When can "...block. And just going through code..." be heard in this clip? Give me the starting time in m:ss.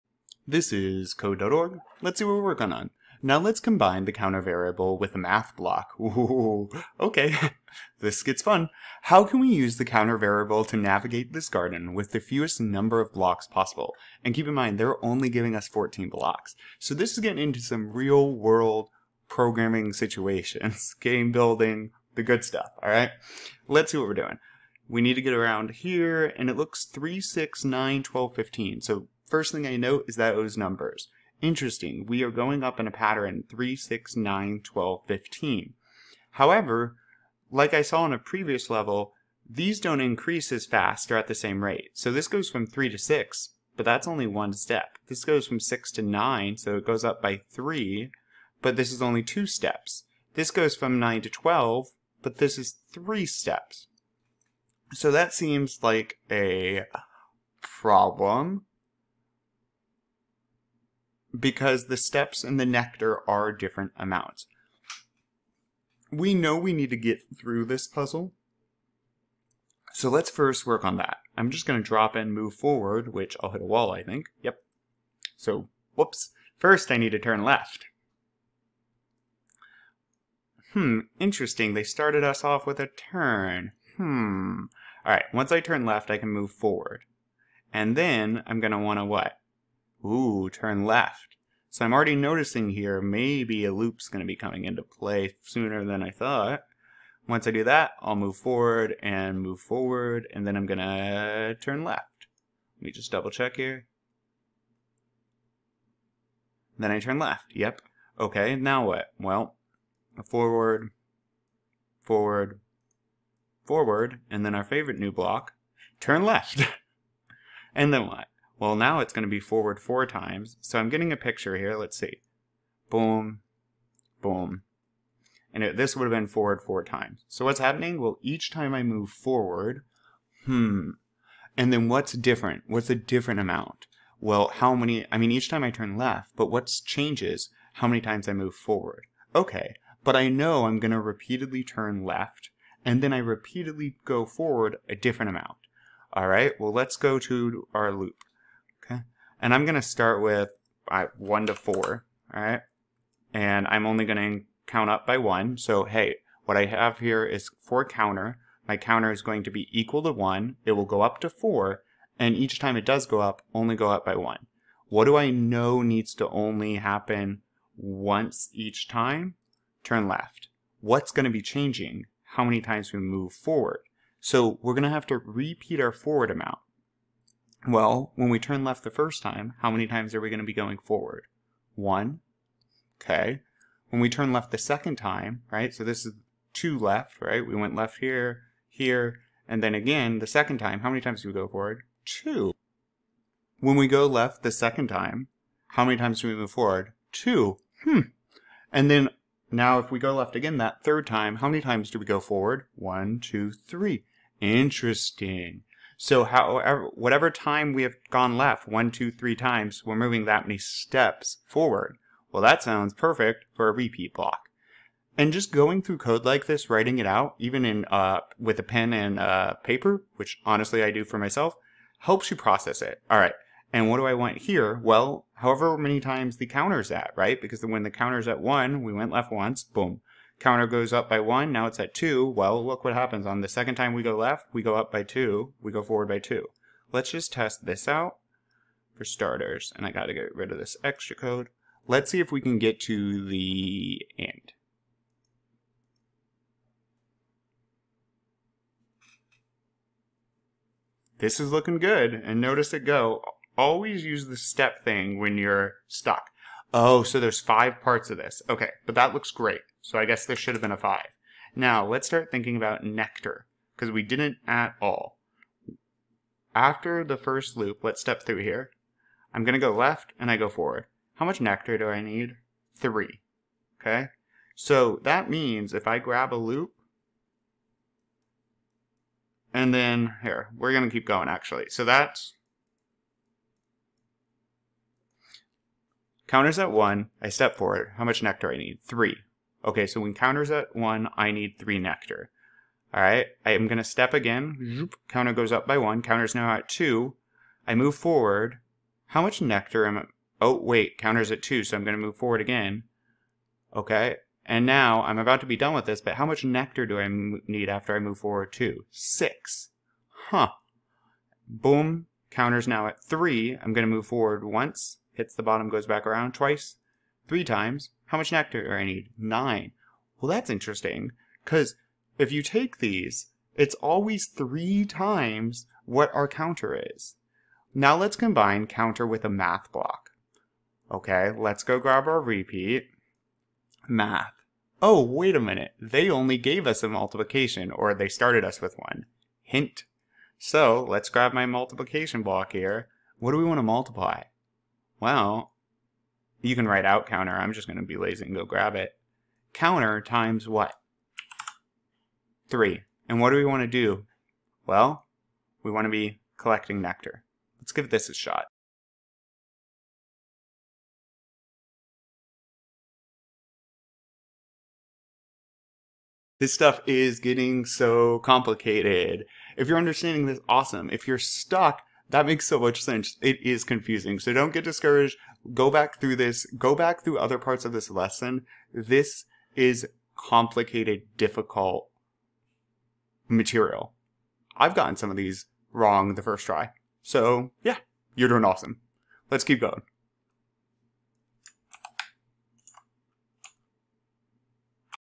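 3:34.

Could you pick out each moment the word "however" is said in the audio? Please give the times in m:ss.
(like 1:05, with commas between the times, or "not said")
0:36, 3:26, 3:45.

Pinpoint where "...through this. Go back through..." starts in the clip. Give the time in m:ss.
6:15.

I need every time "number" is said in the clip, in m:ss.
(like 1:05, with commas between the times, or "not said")
0:12, 0:30.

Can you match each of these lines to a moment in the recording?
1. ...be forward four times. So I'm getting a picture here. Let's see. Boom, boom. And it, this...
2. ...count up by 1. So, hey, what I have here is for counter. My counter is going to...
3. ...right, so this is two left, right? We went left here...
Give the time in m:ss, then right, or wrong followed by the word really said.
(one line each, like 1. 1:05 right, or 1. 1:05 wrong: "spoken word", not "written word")
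1. 1:59 right
2. 2:34 right
3. 3:05 right.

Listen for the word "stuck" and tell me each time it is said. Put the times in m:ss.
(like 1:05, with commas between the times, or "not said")
4:15, 6:11.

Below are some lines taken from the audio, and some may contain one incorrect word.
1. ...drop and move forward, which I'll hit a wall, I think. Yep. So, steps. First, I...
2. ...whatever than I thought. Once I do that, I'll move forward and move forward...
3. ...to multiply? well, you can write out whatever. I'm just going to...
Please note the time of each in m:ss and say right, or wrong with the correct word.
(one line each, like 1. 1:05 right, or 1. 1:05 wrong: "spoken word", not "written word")
1. 1:11 wrong: "whoops", not "steps"
2. 1:35 wrong: "sooner", not "whatever"
3. 5:43 wrong: "counter", not "whatever".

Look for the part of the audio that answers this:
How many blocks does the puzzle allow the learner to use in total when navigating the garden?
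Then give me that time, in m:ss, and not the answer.
0:15.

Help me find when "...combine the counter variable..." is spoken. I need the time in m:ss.
0:03.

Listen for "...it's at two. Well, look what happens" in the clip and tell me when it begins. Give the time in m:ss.
3:51.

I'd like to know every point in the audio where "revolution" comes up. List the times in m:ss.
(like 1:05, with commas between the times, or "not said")
not said.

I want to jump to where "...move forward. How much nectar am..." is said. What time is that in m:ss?
4:57.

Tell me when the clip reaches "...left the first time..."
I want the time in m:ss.
2:58.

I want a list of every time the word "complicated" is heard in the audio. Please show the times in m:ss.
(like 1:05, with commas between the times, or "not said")
6:08, 6:20.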